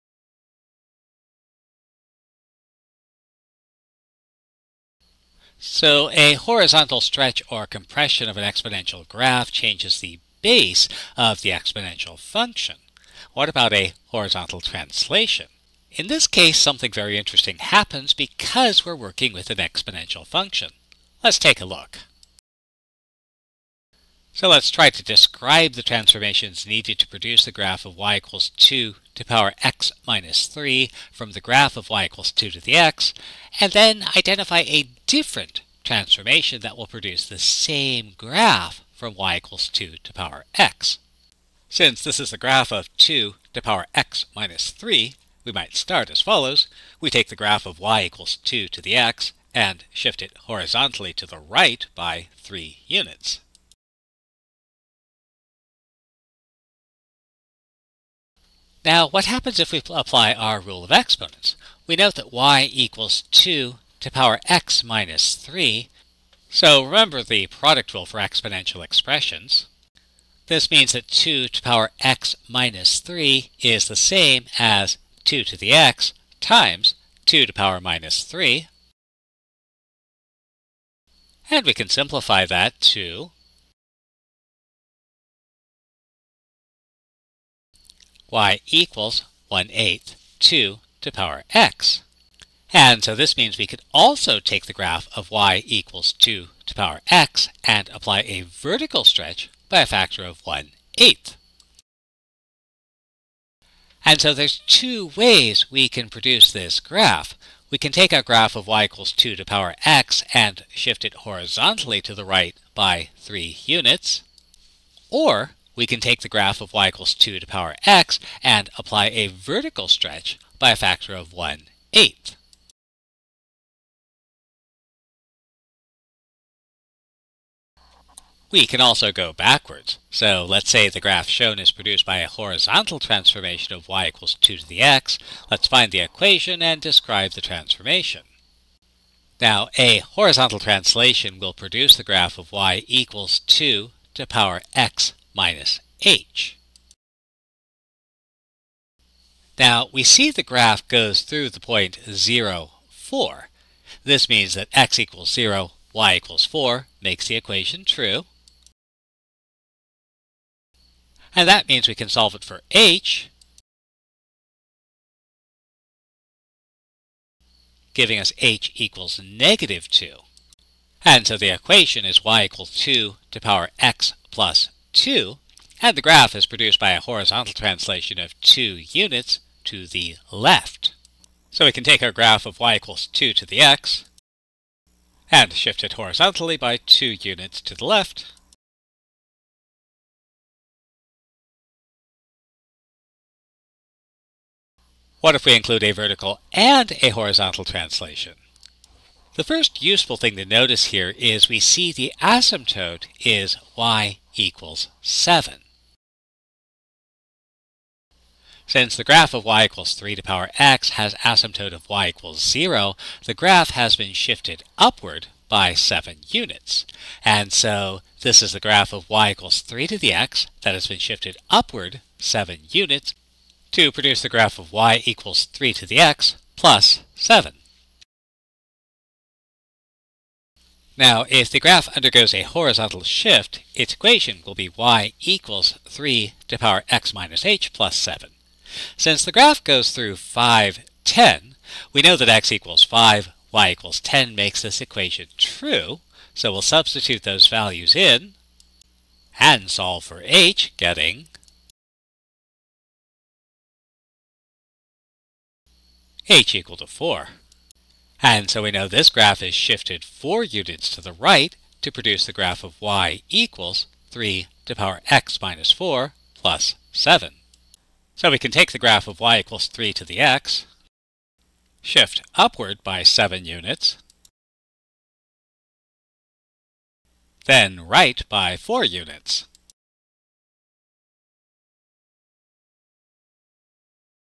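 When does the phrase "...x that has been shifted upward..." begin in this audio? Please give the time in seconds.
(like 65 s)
220 s.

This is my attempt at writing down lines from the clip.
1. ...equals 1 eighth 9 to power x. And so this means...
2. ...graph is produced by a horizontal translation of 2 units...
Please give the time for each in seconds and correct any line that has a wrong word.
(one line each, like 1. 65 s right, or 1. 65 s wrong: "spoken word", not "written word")
1. 88 s wrong: "2", not "9"
2. 176 s right.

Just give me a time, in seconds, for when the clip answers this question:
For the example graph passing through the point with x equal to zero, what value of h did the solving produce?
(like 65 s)
169 s.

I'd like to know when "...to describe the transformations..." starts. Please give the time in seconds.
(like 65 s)
24 s.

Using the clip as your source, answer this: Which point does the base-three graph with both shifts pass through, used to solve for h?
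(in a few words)
(5, 10).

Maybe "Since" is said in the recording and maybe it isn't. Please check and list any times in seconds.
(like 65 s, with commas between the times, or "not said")
41 s, 208 s, 238 s.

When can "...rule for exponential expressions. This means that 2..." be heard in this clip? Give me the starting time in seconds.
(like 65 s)
67 s.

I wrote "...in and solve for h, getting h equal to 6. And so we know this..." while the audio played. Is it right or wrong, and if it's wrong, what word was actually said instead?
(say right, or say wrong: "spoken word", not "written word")
wrong: "4", not "6".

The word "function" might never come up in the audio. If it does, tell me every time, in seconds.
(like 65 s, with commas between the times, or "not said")
12 s, 20 s.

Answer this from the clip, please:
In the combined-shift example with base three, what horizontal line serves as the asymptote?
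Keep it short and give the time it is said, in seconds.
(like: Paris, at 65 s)
y = 7, at 203 s.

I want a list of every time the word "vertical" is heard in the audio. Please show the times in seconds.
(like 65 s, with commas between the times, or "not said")
98 s, 119 s, 195 s.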